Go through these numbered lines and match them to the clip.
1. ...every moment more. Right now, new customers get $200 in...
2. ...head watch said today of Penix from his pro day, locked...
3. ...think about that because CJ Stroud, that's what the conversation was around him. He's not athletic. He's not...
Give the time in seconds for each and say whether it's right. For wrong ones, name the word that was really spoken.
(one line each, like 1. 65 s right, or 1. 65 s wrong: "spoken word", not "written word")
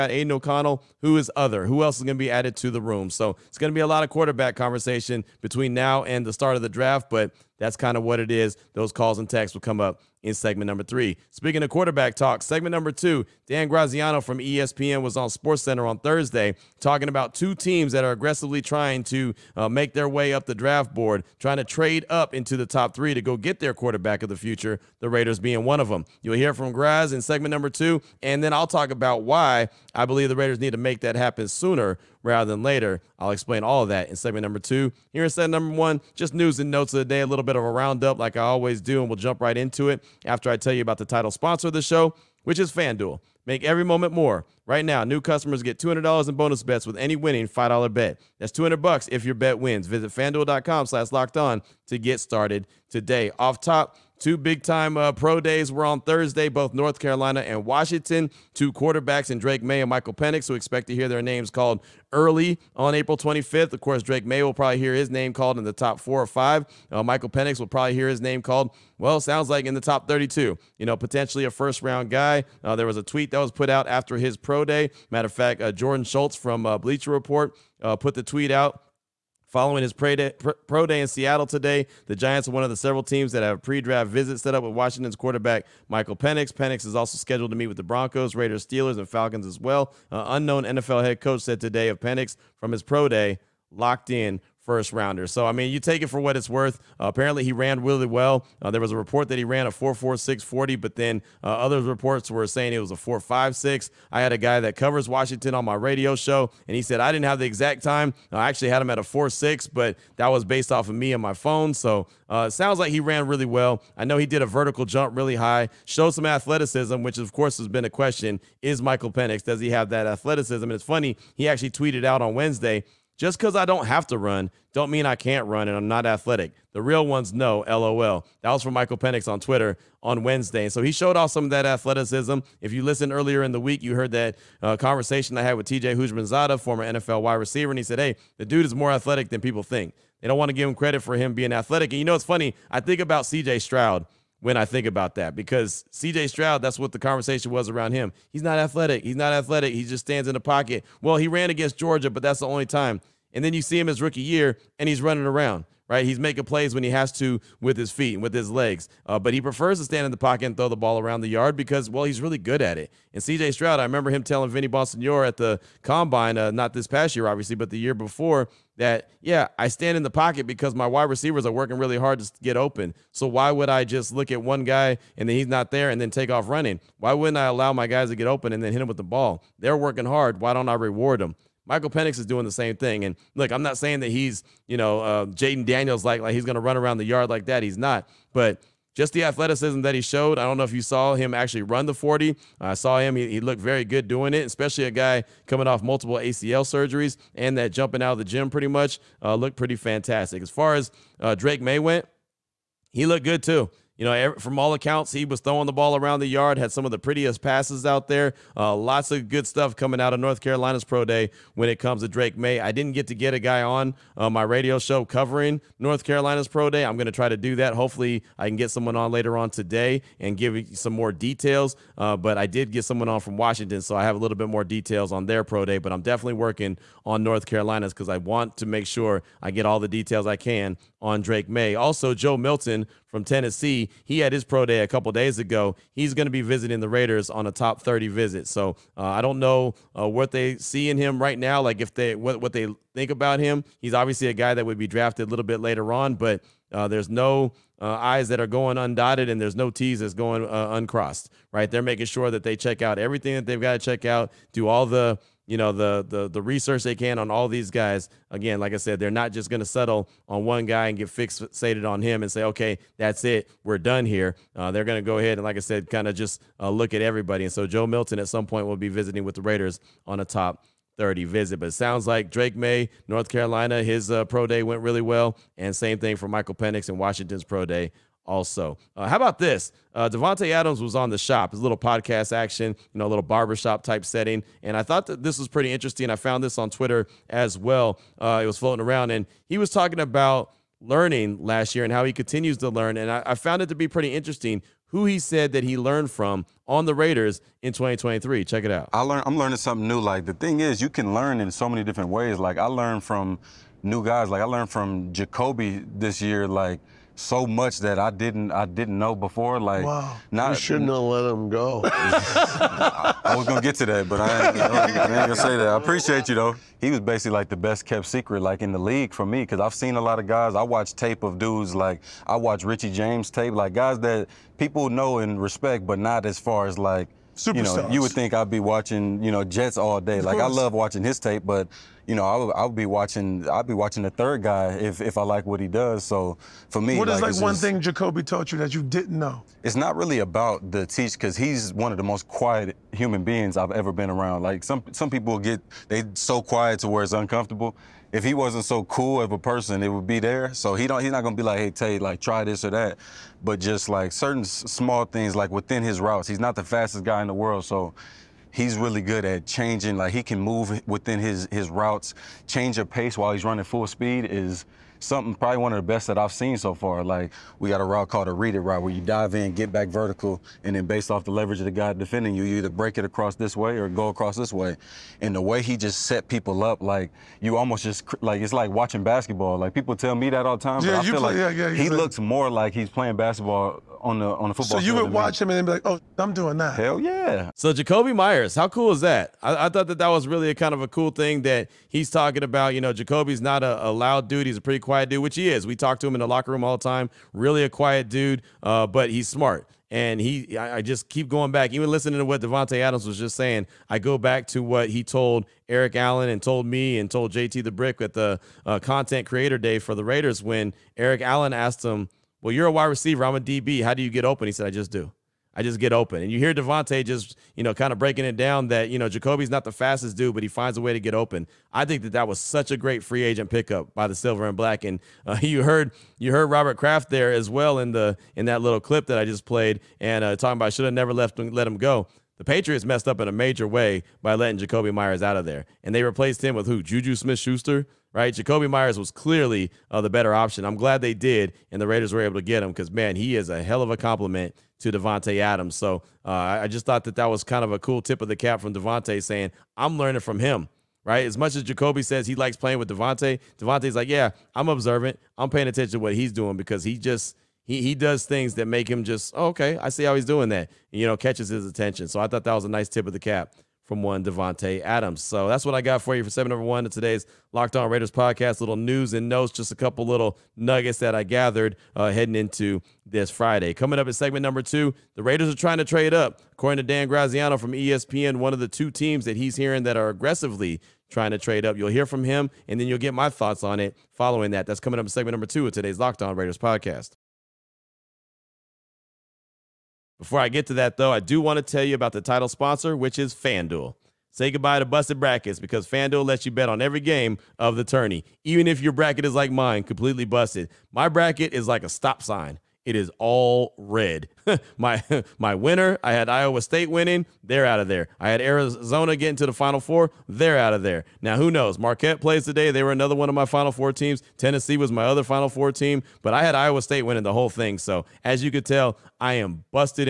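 1. 43 s right
2. 91 s wrong: "coach", not "watch"
3. 144 s right.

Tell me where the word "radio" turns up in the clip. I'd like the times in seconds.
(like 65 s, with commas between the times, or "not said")
105 s, 214 s.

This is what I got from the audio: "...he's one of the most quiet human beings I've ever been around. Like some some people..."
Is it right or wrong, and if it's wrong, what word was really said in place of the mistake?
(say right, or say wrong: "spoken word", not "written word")
right.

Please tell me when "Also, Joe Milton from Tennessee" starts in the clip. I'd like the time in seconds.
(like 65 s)
231 s.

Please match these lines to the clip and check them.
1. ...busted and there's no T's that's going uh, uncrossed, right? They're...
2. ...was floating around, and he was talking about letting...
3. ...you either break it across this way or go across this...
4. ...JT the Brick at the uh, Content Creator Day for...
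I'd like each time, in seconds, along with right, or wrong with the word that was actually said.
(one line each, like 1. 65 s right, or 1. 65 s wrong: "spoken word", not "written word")
1. 248 s wrong: "undotted", not "busted"
2. 288 s wrong: "learning", not "letting"
3. 372 s right
4. 407 s right.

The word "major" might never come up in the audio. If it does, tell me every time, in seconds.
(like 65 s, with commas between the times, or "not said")
433 s.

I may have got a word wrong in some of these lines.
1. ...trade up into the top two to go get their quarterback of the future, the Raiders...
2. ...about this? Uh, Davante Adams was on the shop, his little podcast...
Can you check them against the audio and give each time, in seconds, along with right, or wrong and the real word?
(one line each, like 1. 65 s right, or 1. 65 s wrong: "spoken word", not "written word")
1. 21 s wrong: "three", not "two"
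2. 279 s right.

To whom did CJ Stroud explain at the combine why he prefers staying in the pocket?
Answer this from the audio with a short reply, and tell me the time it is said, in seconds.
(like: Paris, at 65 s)
Vinny Bonsignore, at 164 s.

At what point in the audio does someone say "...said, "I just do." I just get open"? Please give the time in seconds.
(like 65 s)
414 s.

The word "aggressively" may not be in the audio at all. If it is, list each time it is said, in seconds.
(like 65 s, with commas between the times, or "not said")
18 s, 480 s.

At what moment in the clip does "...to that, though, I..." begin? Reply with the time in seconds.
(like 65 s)
490 s.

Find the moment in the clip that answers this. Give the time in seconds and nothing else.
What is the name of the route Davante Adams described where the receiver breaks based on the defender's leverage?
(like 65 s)
368 s.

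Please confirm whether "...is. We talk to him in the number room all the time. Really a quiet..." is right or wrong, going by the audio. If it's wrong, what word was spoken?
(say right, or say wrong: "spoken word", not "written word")
wrong: "locker", not "number".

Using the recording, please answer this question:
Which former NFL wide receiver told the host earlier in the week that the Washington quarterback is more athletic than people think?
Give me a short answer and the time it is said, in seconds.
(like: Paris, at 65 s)
TJ Houshmandzadeh, at 135 s.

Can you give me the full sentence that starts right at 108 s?
I actually had him at a 4.6, but that was based off of me and my phone.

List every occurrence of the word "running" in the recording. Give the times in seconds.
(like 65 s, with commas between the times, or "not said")
155 s, 176 s, 363 s.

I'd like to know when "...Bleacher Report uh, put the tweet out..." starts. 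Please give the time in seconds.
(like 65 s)
76 s.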